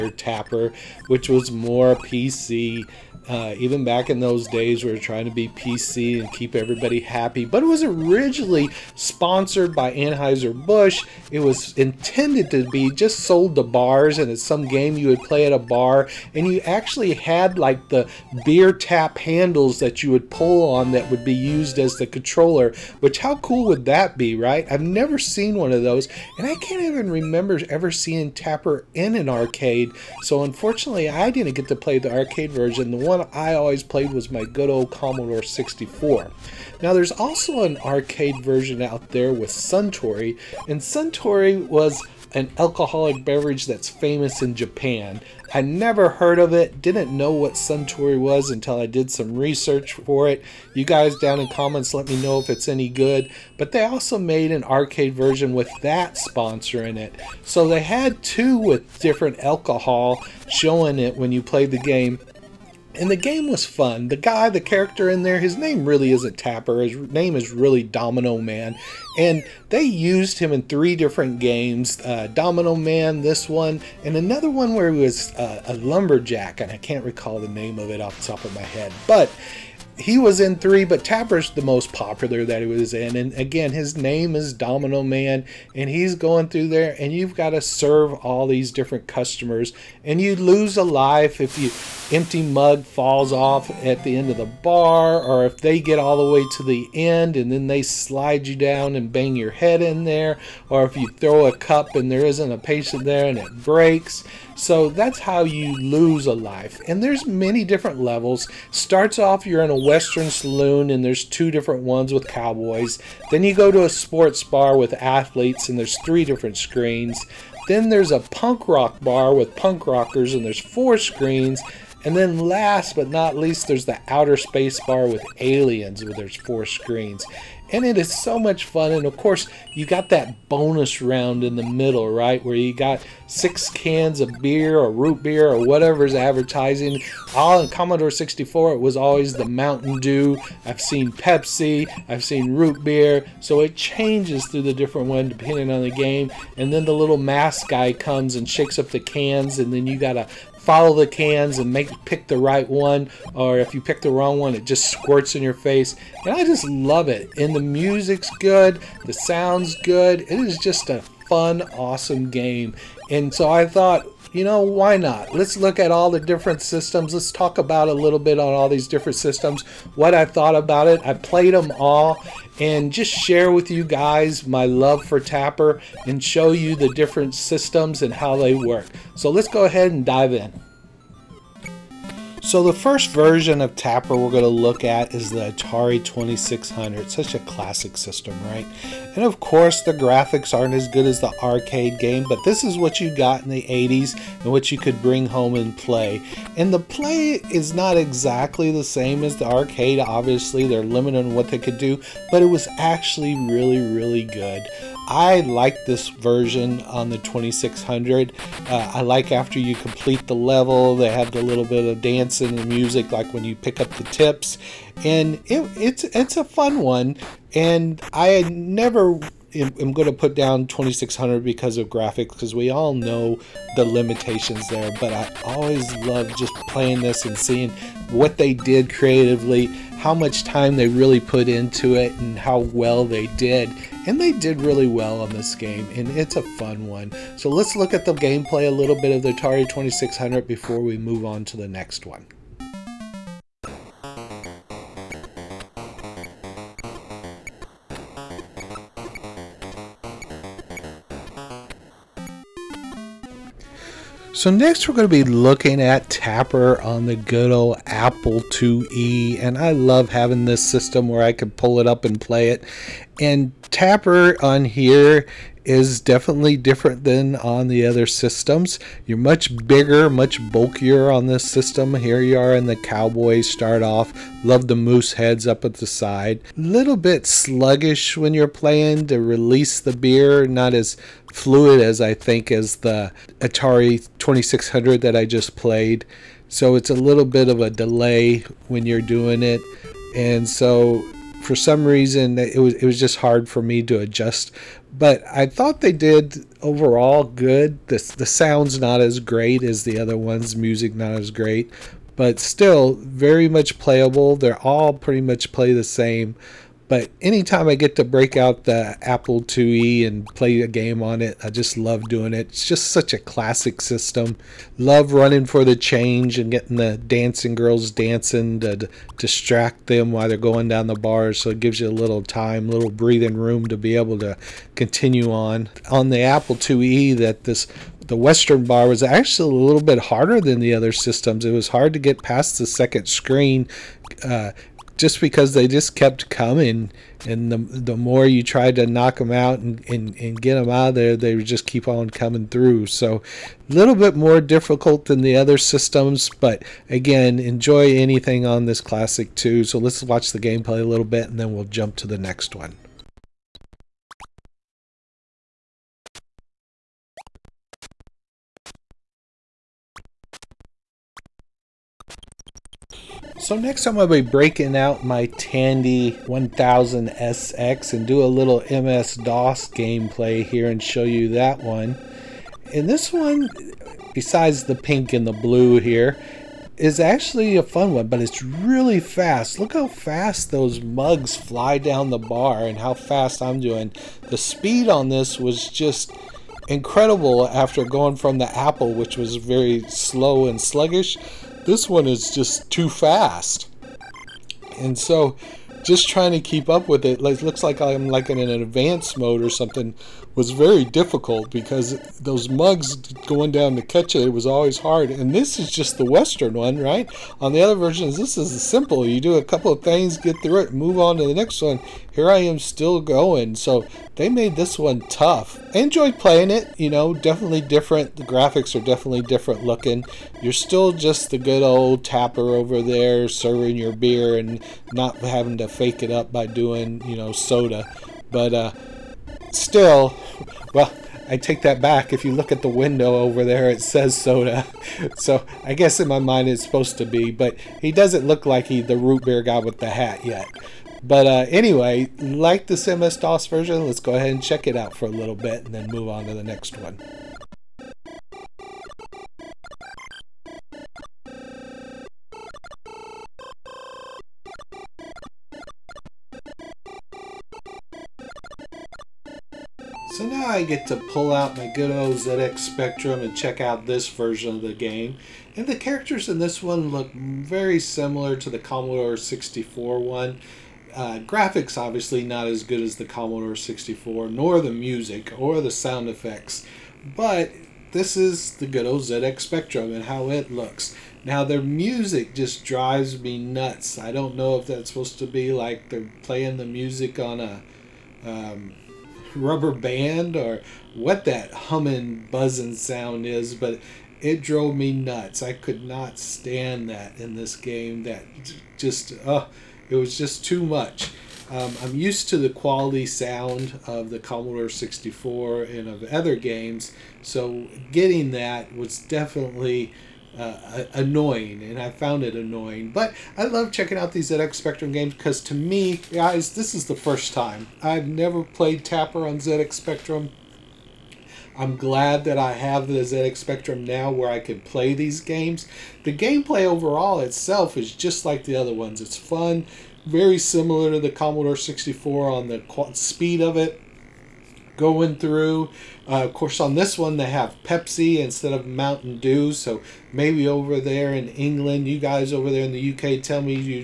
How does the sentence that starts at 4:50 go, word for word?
And so for some reason it was it was just hard for me to adjust but I thought they did overall good.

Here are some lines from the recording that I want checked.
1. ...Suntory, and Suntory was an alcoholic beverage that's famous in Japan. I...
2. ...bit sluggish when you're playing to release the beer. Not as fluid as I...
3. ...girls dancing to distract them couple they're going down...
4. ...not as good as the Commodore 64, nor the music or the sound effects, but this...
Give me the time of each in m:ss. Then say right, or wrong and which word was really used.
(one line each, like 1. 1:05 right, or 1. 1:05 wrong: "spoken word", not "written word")
1. 0:39 right
2. 4:36 right
3. 5:17 wrong: "while", not "couple"
4. 7:52 right.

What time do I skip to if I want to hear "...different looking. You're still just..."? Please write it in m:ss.
6:59.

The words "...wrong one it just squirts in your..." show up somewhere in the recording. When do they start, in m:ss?
2:34.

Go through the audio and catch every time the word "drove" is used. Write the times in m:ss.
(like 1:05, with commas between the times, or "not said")
8:14.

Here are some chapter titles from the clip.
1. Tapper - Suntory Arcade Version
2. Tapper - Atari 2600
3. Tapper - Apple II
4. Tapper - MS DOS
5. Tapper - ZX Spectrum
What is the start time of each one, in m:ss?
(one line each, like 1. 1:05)
1. 0:40
2. 3:01
3. 4:13
4. 6:03
5. 7:40.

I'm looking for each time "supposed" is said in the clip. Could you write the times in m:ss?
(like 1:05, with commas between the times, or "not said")
7:16, 8:04.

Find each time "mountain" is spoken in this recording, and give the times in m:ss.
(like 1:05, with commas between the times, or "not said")
2:19, 8:58.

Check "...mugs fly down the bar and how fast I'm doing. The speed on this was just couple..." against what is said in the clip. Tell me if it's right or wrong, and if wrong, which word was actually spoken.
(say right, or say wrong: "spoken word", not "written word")
wrong: "incredible", not "couple".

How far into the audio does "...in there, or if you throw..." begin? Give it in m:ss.
1:39.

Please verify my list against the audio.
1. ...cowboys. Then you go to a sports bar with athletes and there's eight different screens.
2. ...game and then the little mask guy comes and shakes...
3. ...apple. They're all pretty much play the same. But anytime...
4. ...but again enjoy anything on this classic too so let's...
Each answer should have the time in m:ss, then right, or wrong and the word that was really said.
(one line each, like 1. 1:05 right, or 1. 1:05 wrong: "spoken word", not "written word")
1. 1:52 wrong: "three", not "eight"
2. 2:25 right
3. 5:03 wrong: "playable", not "apple"
4. 5:46 right.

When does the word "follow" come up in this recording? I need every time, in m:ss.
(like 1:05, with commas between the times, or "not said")
2:30.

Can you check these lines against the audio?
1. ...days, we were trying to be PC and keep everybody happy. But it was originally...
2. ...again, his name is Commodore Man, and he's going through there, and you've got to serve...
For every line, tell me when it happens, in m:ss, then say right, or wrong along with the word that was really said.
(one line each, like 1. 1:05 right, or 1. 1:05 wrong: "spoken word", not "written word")
1. 0:04 right
2. 1:23 wrong: "Domino", not "Commodore".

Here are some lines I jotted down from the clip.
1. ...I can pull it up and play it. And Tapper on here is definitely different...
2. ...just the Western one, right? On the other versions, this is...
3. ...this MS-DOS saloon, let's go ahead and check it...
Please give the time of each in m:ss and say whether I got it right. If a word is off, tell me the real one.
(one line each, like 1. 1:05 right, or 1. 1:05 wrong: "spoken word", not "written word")
1. 4:21 right
2. 6:45 right
3. 7:22 wrong: "version", not "saloon".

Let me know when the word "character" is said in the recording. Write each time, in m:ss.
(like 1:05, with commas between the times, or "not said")
1:04, 7:45.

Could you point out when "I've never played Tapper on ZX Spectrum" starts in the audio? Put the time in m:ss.
8:37.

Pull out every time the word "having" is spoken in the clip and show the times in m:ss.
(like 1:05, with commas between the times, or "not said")
4:20, 7:05.